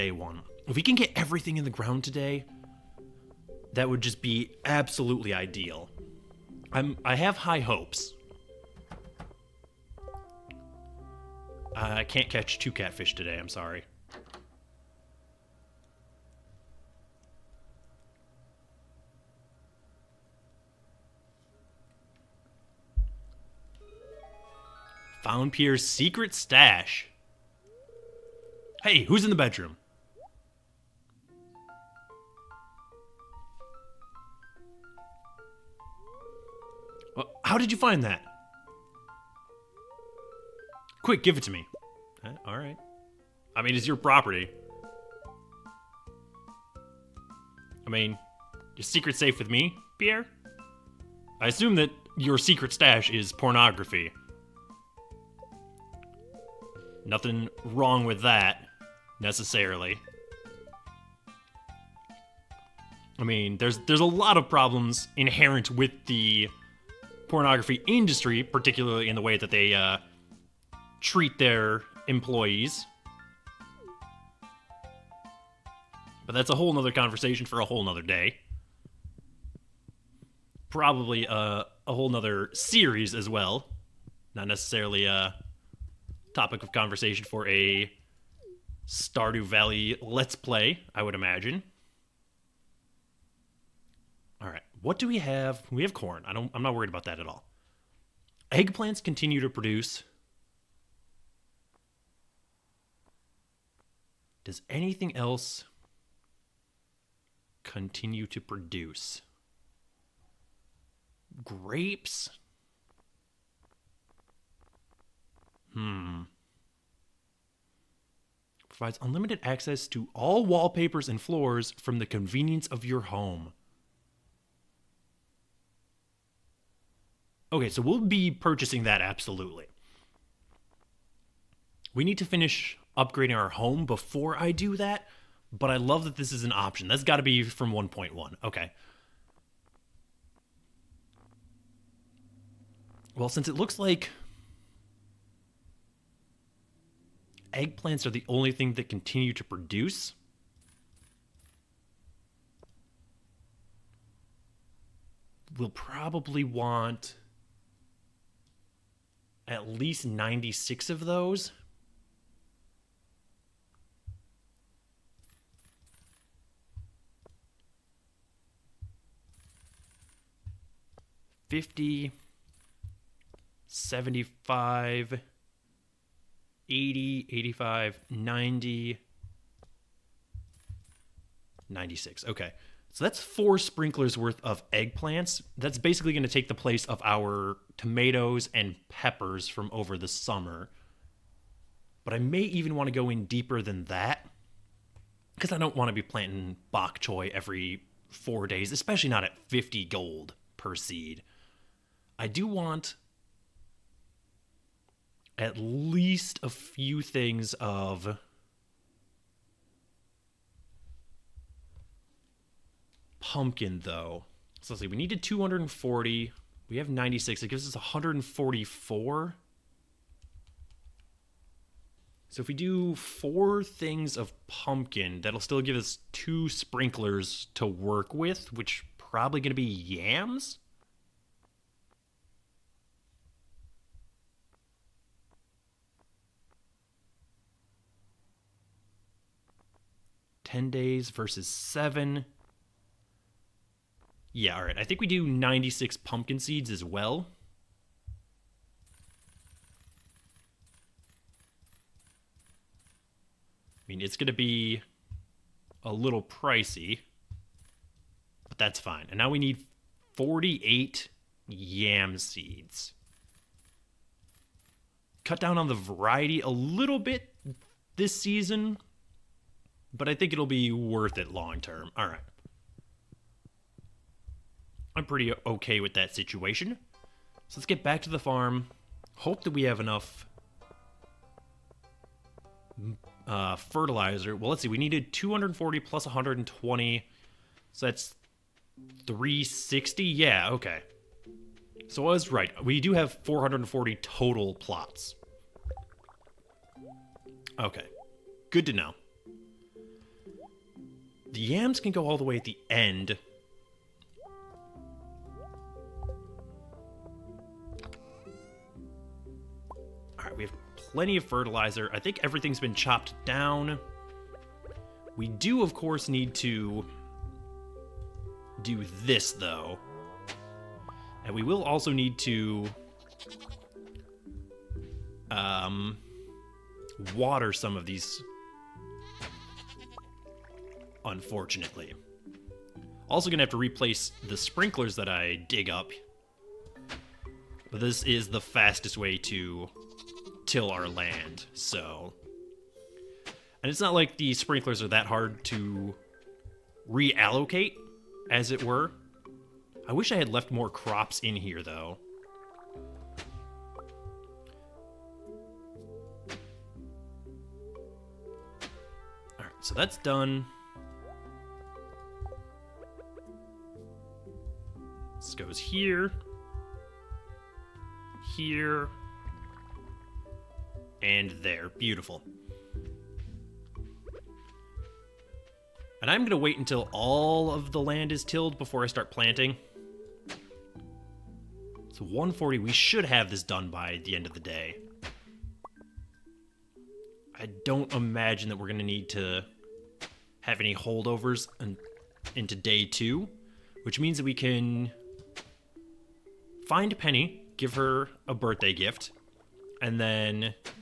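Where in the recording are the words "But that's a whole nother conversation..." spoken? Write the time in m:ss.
1:16.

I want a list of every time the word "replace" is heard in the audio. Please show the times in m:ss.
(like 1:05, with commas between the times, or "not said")
5:33.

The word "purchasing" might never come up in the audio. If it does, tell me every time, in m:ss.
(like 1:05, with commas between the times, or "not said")
2:08.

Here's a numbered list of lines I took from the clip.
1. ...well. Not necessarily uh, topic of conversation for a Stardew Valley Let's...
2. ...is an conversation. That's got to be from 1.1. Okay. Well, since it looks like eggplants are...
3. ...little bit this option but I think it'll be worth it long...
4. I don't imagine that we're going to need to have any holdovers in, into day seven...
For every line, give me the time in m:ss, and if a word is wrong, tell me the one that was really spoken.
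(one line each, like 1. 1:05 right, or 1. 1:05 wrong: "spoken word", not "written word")
1. 1:23 right
2. 2:16 wrong: "option", not "conversation"
3. 4:26 wrong: "season", not "option"
4. 6:27 wrong: "two", not "seven".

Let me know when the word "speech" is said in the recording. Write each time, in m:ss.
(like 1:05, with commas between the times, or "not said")
not said.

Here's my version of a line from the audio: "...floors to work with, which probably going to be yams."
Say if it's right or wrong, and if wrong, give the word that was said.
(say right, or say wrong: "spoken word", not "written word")
wrong: "sprinklers", not "floors".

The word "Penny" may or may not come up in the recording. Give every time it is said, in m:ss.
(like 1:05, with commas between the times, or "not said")
6:36.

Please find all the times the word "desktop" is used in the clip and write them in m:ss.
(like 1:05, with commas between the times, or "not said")
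not said.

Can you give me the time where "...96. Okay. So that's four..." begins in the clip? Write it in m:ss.
3:01.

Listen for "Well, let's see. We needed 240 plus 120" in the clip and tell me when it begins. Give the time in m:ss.
4:44.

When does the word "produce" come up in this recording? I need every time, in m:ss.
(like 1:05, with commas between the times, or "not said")
1:39, 1:48, 2:29.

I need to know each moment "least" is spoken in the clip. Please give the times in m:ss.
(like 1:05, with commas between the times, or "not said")
2:39, 3:25.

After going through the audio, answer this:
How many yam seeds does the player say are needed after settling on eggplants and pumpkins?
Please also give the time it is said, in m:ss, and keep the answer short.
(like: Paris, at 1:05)
48, at 4:20.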